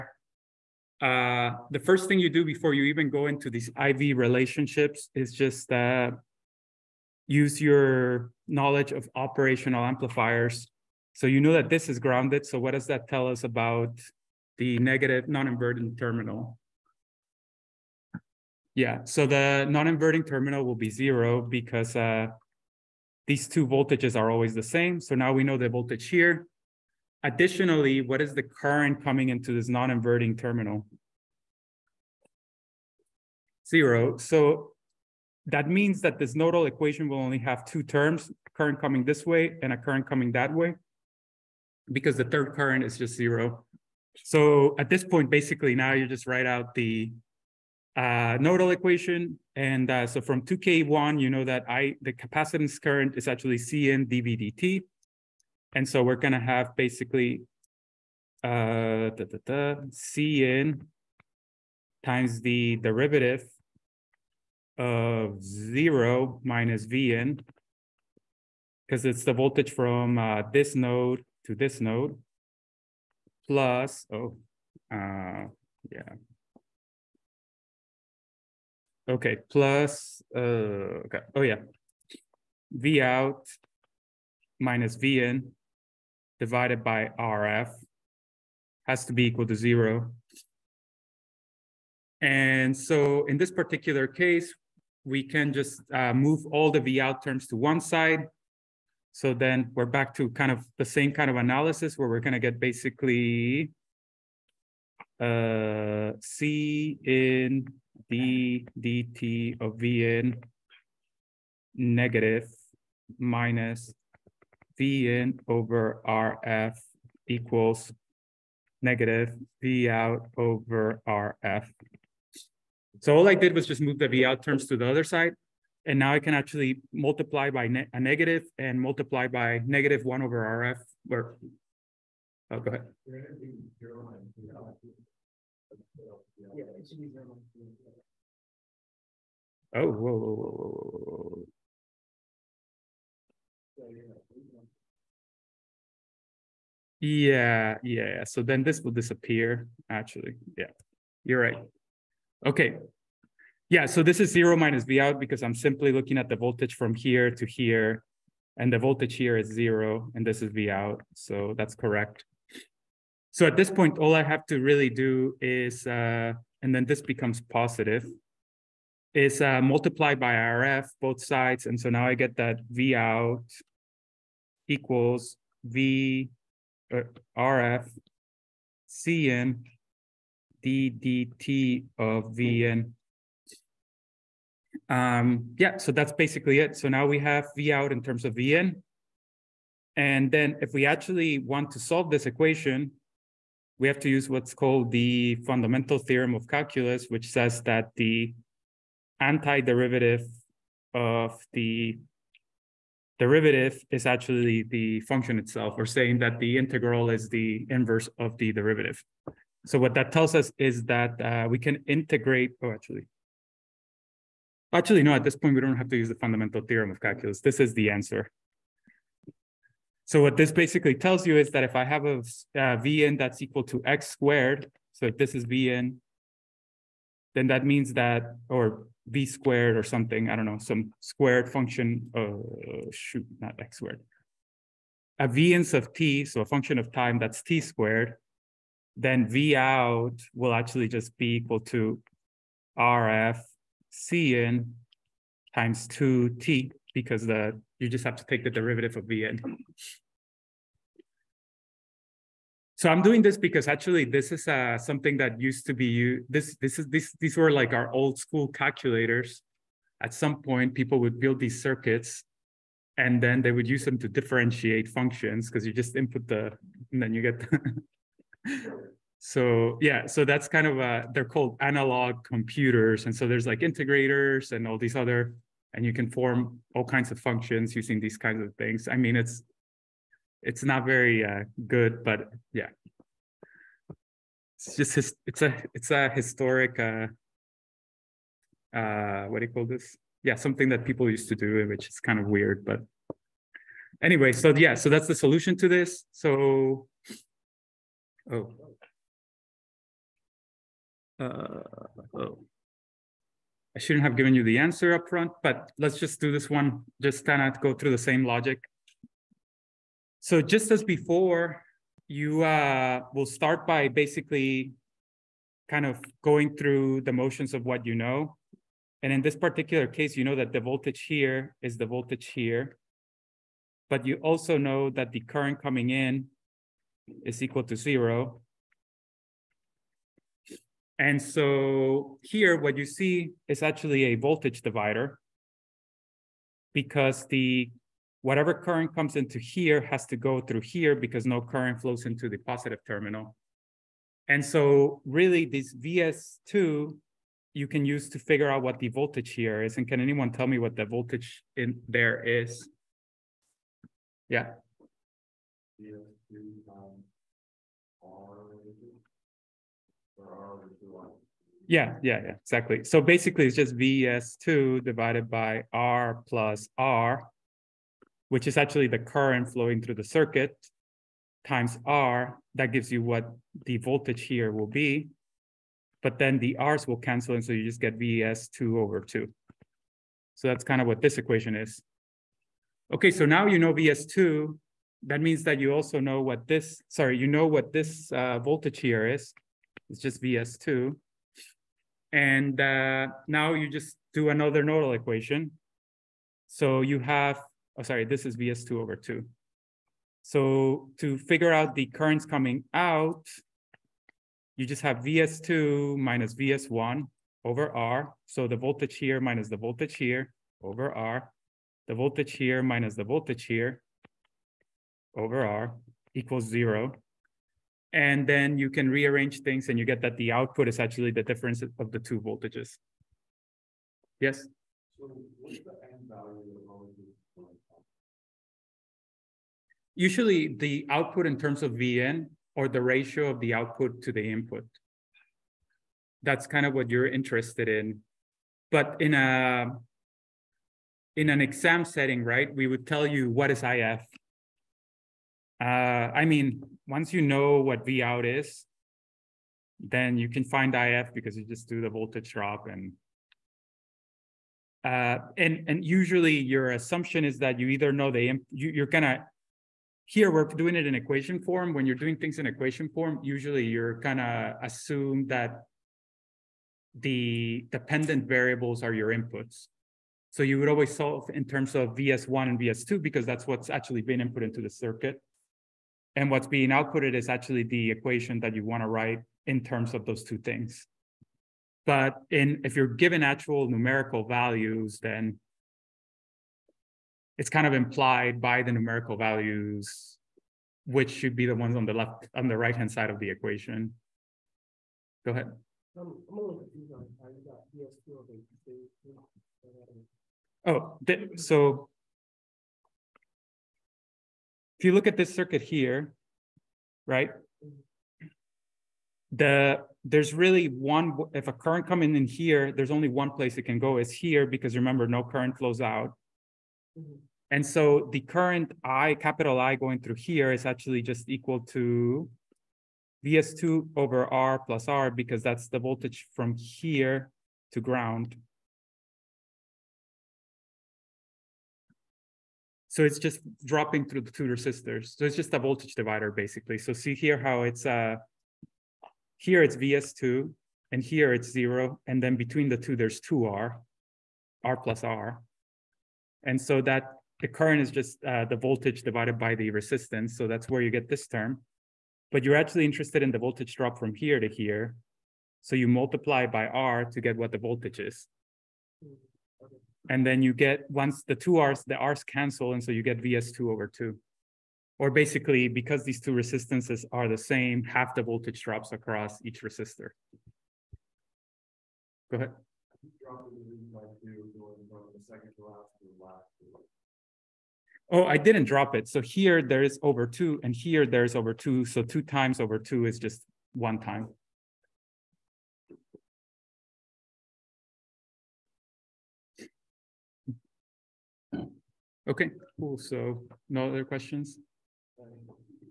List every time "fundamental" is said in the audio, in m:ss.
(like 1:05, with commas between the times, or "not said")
3:15, 3:36.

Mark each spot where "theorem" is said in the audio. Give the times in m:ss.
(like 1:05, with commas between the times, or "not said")
3:15, 3:36.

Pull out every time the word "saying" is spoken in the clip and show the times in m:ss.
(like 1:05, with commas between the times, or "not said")
3:25.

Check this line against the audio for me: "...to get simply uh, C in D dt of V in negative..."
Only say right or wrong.
wrong.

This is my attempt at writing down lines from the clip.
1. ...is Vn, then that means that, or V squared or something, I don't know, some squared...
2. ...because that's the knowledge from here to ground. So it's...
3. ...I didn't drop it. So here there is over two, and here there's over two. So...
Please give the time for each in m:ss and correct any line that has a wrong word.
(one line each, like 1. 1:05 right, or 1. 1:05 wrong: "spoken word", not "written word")
1. 3:45 right
2. 8:45 wrong: "voltage", not "knowledge"
3. 9:38 right.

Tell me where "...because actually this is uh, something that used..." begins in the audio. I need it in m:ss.
4:13.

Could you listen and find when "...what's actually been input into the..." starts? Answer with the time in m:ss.
7:53.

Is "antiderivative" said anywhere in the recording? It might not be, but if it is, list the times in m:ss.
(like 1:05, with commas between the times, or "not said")
3:19.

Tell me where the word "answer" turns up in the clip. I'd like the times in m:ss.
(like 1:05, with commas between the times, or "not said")
3:37, 5:04.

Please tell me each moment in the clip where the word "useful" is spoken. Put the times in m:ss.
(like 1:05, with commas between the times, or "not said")
not said.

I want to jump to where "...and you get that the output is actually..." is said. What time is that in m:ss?
6:59.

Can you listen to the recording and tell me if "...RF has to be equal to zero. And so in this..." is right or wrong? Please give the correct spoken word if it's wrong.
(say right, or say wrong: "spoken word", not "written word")
right.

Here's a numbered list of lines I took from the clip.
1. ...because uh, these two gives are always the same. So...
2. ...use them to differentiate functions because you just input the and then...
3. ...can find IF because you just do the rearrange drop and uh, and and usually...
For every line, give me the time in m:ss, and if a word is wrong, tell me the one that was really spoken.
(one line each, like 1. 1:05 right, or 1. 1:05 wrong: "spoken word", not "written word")
1. 0:21 wrong: "voltages", not "gives"
2. 4:23 right
3. 7:30 wrong: "voltage", not "rearrange".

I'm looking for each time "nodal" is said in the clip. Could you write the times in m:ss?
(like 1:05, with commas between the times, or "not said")
0:36, 0:48, 6:34.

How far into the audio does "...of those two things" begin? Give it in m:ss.
7:59.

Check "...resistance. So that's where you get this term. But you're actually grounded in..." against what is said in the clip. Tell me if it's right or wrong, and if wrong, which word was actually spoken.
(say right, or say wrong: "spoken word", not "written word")
wrong: "interested", not "grounded".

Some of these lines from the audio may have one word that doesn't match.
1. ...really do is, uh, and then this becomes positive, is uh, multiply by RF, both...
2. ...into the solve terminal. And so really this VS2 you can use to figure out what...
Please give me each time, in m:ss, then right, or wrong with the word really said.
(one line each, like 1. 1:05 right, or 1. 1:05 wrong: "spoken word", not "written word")
1. 2:44 right
2. 5:42 wrong: "positive", not "solve".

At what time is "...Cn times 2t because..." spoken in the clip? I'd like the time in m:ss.
4:03.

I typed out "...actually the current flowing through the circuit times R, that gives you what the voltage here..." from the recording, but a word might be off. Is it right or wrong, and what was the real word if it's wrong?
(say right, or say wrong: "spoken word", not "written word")
right.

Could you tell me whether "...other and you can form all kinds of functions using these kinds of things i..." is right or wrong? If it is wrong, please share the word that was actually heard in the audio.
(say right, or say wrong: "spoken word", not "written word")
right.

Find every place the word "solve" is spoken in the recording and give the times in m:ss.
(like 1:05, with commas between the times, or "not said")
3:11, 7:50.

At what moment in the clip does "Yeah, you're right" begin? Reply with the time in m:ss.
2:30.